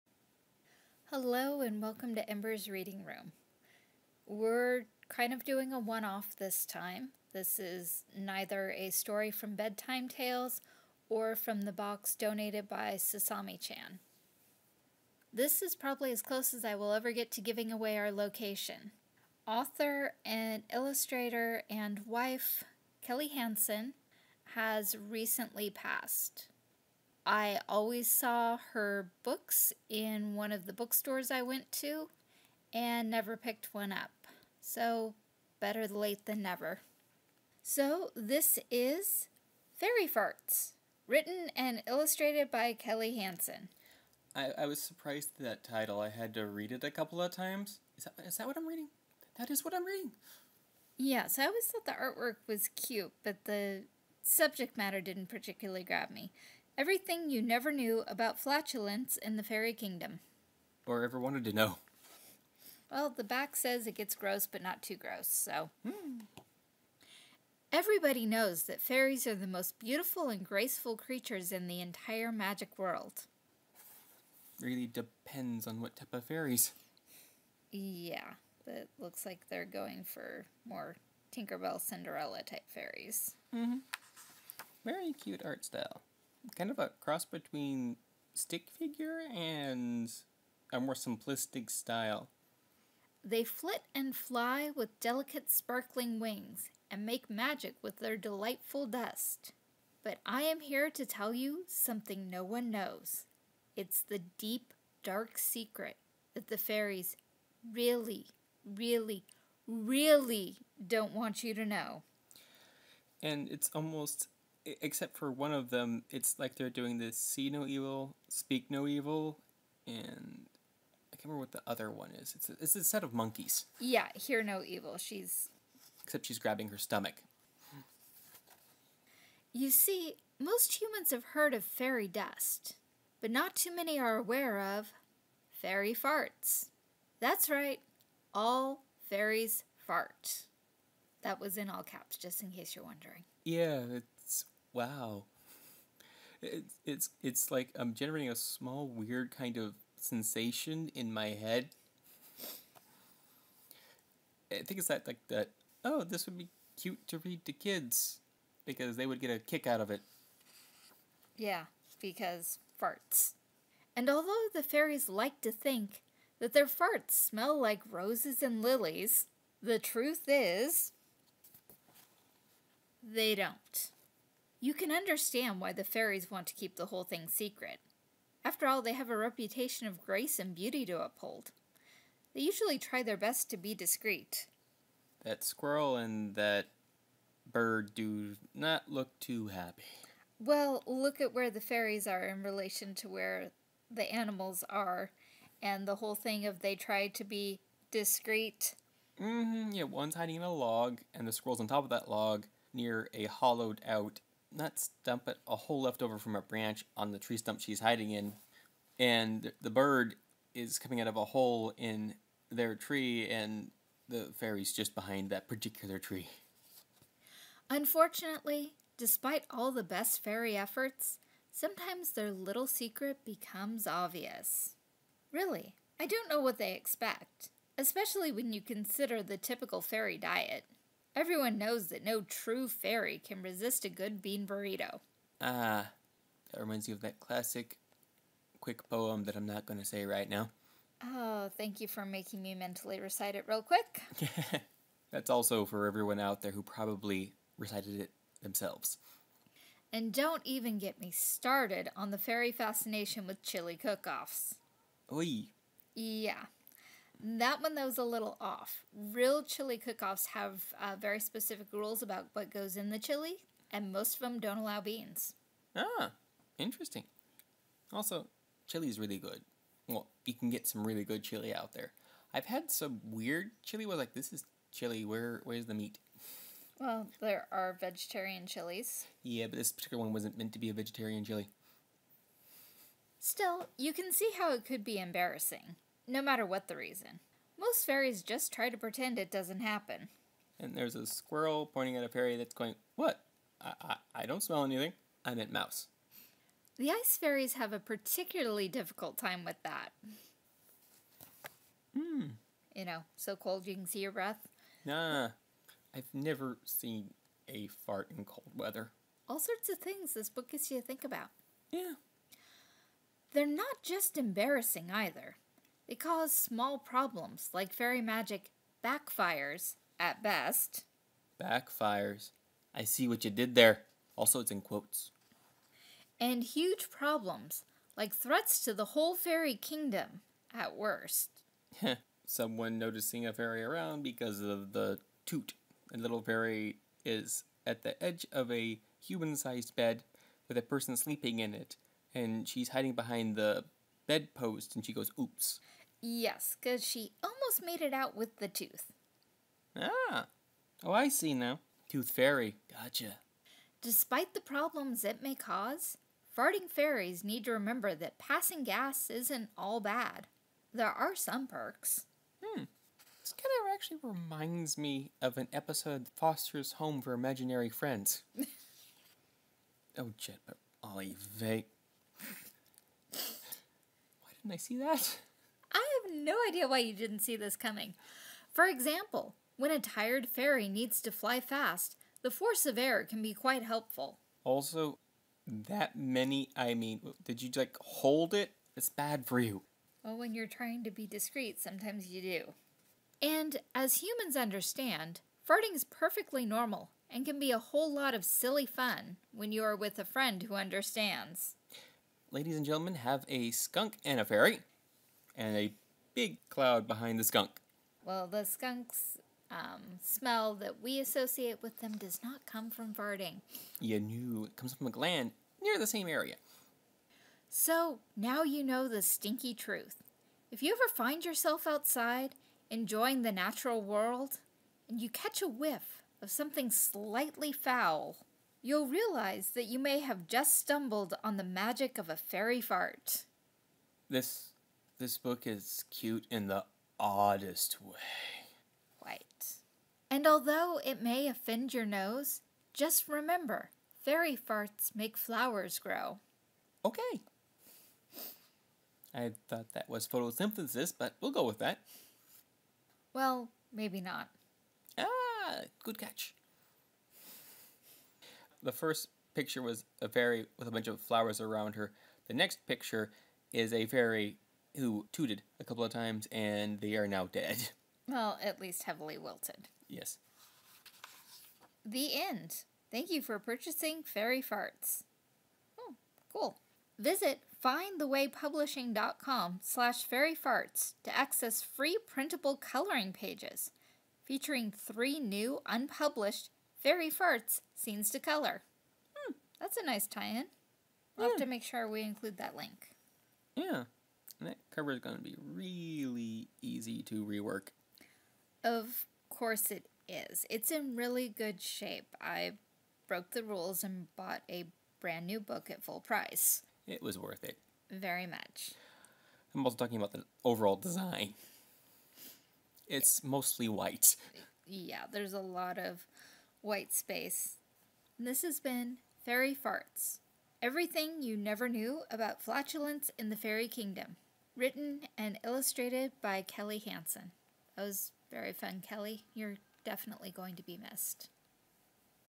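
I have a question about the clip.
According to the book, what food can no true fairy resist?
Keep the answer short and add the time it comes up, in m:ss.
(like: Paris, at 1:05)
bean burrito, at 3:54.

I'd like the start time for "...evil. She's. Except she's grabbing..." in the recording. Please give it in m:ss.
2:04.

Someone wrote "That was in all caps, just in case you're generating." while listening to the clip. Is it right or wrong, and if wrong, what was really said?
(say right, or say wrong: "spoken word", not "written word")
wrong: "wondering", not "generating".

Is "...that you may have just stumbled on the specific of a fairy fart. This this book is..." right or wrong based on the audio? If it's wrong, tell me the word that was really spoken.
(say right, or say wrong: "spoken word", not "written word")
wrong: "magic", not "specific".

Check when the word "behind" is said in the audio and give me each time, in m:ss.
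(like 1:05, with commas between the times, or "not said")
3:34, 5:42, 6:46.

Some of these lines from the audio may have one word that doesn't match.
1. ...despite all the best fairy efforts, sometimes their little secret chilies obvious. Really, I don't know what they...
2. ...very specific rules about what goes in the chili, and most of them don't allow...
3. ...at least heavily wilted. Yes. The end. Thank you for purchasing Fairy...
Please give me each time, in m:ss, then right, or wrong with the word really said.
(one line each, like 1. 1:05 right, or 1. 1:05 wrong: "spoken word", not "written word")
1. 3:38 wrong: "becomes", not "chilies"
2. 4:20 right
3. 7:48 right.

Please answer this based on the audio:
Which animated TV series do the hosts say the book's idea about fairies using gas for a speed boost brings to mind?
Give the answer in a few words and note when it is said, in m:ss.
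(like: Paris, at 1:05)
Foster's Home for Imaginary Friends, at 6:06.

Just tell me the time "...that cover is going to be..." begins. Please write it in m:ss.
8:14.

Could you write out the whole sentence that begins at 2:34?
I think it's that like that.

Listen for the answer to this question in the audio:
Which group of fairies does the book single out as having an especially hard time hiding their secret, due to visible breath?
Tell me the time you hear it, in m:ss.
4:56.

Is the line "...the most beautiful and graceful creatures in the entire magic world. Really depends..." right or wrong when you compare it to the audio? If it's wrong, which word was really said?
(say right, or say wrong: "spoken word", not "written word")
right.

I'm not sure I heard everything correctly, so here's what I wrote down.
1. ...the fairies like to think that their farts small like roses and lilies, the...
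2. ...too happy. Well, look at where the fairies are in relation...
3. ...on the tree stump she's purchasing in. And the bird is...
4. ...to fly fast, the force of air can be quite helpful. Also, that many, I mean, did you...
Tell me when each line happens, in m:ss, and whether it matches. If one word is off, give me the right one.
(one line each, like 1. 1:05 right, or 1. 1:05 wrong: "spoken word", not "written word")
1. 2:44 wrong: "smell", not "small"
2. 3:09 right
3. 3:26 wrong: "hiding", not "purchasing"
4. 6:21 right.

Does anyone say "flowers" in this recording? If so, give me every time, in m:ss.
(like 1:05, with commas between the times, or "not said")
7:25, 7:41.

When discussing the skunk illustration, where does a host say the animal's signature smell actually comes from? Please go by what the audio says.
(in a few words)
a gland.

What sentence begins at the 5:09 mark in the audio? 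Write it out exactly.
All sorts of things this book gets you to think about.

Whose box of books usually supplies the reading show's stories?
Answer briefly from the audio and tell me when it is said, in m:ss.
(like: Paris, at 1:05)
Sasami chan, at 0:12.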